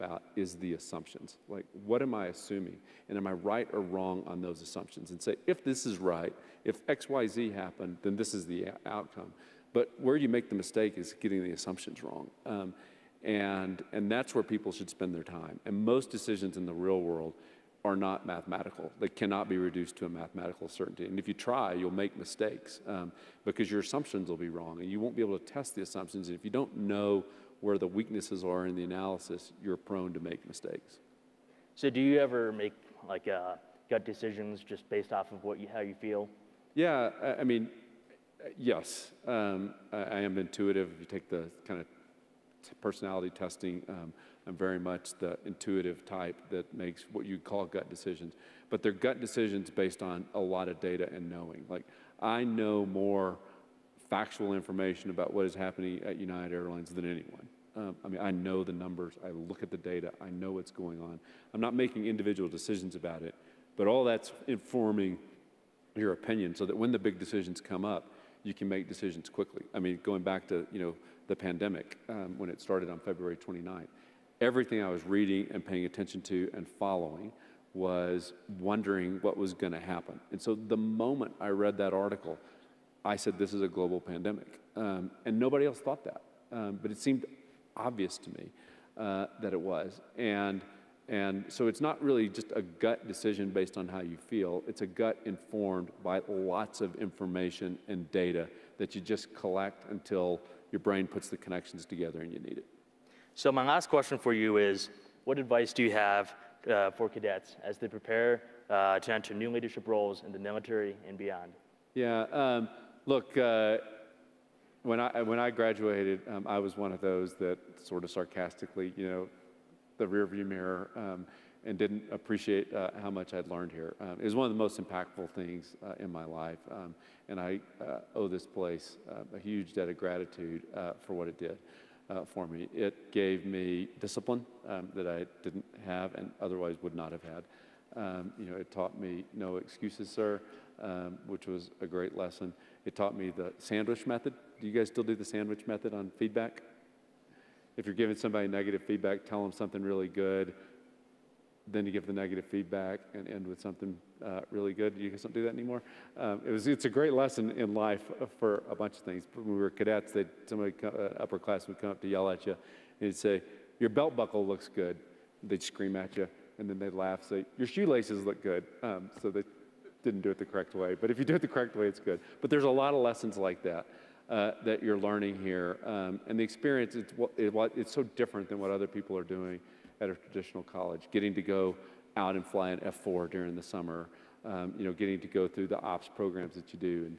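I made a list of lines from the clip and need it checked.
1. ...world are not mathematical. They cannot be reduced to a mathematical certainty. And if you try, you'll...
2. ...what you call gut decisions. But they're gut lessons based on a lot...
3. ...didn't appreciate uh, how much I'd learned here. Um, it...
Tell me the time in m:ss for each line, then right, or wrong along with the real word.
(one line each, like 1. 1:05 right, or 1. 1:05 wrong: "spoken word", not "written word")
1. 0:17 right
2. 0:47 wrong: "decisions", not "lessons"
3. 2:01 right.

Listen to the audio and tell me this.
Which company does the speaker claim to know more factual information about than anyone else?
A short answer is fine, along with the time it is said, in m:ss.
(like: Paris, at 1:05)
United Airlines, at 0:56.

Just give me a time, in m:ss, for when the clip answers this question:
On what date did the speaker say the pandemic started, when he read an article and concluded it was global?
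1:12.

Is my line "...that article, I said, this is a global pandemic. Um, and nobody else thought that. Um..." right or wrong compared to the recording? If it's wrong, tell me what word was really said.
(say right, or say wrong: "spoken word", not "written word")
right.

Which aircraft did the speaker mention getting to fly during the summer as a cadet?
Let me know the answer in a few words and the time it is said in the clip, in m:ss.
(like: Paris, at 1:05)
F4, at 3:02.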